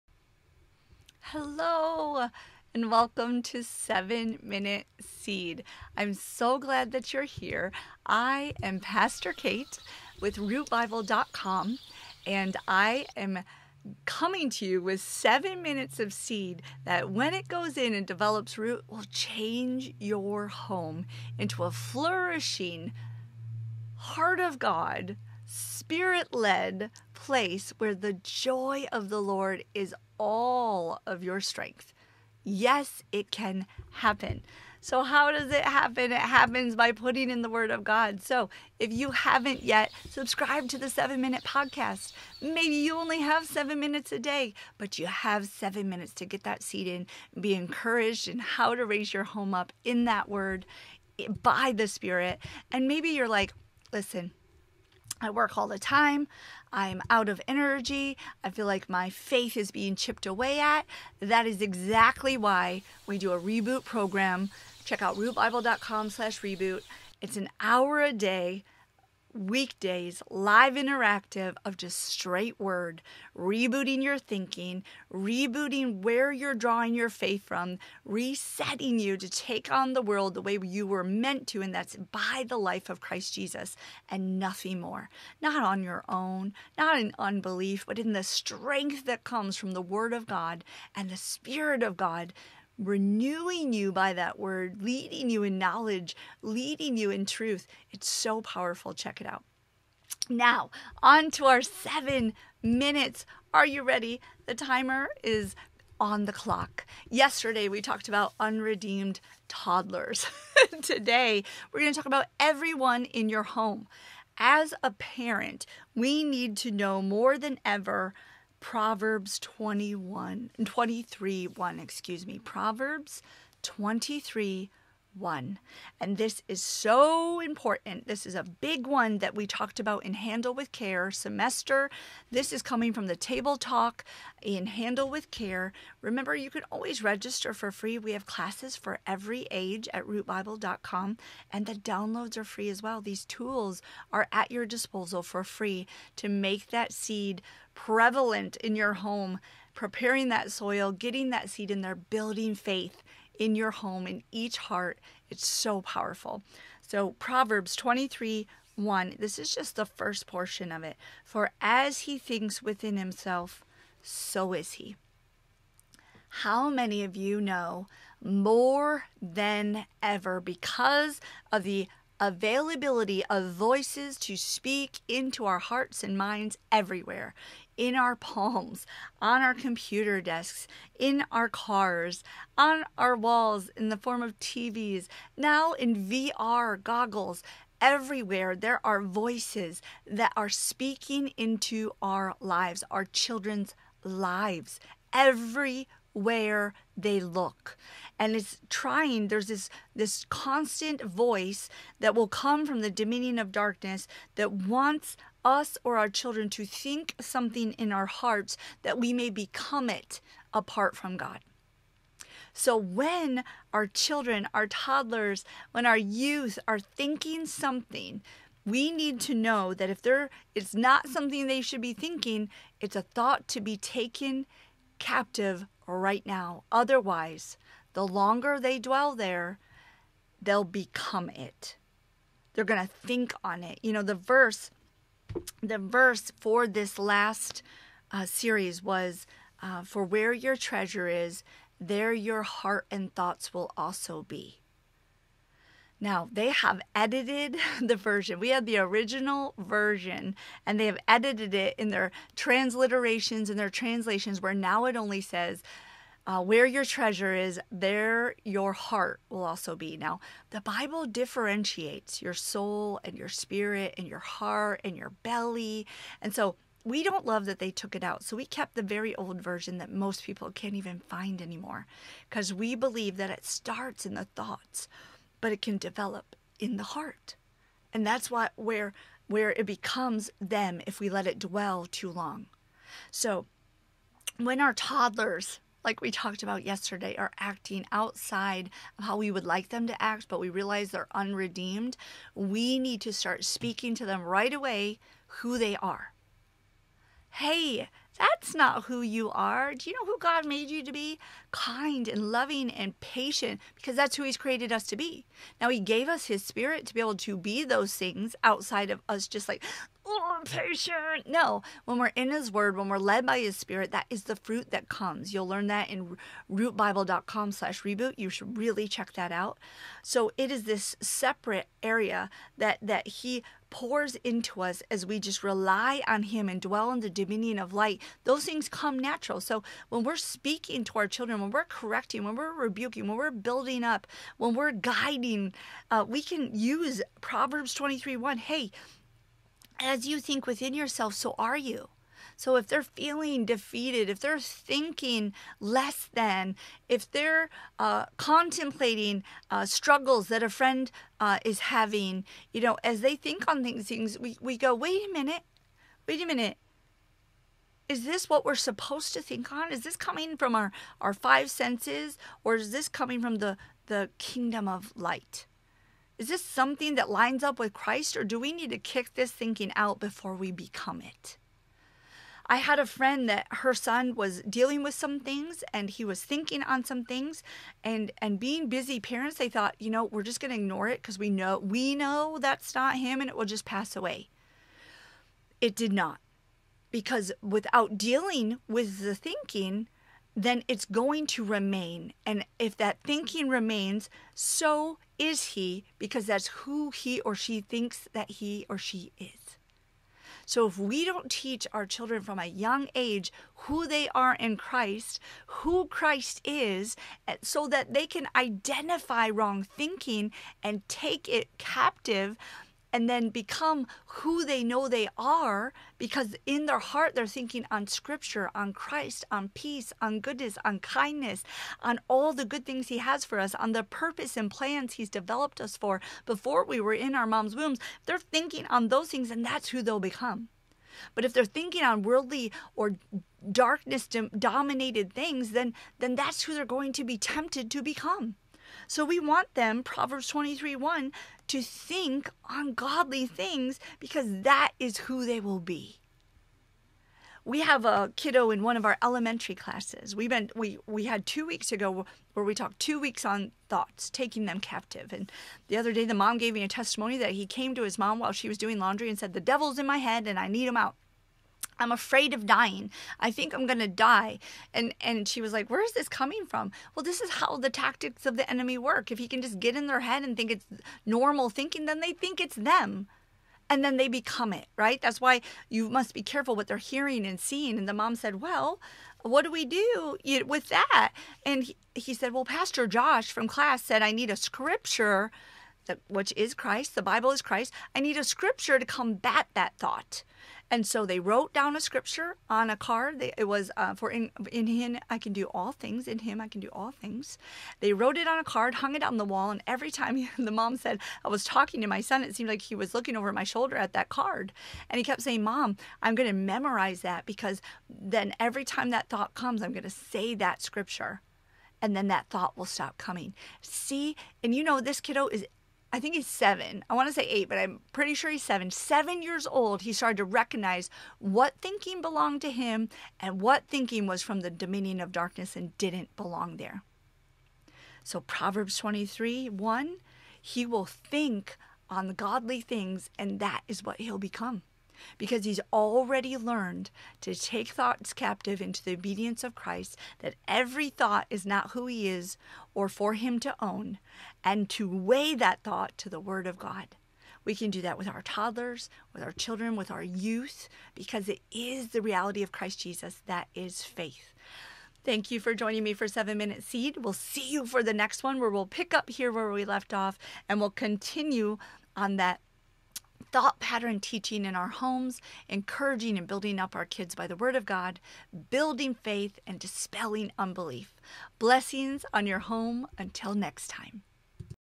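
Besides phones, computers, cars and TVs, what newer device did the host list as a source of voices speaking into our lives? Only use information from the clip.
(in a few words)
VR goggles.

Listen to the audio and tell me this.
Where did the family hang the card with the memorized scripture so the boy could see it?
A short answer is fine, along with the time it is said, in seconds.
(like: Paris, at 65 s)
on the wall, at 499 s.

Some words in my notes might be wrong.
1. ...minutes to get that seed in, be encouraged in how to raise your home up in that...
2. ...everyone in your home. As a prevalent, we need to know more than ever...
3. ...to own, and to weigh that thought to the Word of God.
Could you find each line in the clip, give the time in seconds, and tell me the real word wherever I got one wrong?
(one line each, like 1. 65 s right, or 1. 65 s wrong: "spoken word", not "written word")
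1. 45 s right
2. 112 s wrong: "parent", not "prevalent"
3. 543 s right.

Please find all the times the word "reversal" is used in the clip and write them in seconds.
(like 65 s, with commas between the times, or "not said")
not said.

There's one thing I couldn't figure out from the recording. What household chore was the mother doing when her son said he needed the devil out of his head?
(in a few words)
laundry.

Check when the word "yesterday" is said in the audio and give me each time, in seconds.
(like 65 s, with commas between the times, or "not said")
107 s, 286 s.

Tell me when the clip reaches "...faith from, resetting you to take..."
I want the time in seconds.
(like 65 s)
77 s.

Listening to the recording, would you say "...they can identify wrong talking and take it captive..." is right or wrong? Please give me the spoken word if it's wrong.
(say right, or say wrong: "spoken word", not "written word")
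wrong: "thinking", not "talking".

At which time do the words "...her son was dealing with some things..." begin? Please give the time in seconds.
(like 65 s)
373 s.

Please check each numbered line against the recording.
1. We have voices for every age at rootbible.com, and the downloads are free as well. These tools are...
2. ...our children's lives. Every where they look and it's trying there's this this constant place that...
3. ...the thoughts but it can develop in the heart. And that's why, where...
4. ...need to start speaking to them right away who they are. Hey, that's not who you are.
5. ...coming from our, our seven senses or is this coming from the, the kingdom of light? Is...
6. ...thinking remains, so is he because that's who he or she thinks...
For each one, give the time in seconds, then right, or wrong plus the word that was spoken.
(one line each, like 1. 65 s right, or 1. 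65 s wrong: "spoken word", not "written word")
1. 137 s wrong: "classes", not "voices"
2. 192 s wrong: "voice", not "place"
3. 274 s right
4. 292 s right
5. 359 s wrong: "five", not "seven"
6. 393 s right.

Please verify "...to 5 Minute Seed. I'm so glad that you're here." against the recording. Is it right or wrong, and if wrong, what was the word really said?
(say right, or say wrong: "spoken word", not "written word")
wrong: "7", not "5".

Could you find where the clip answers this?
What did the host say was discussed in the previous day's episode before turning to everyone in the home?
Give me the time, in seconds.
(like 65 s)
108 s.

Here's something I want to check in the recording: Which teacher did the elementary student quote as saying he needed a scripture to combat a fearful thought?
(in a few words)
Pastor Josh.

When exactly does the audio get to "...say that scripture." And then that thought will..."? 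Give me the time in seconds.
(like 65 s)
509 s.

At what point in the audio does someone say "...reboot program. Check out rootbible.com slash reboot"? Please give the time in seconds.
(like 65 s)
63 s.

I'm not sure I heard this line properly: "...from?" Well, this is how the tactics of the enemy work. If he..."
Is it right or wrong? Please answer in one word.
right.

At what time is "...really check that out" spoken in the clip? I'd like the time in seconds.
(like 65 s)
318 s.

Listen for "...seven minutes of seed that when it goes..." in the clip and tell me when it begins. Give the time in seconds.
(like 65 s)
14 s.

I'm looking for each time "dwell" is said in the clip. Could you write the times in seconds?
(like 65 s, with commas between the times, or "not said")
228 s, 281 s, 326 s.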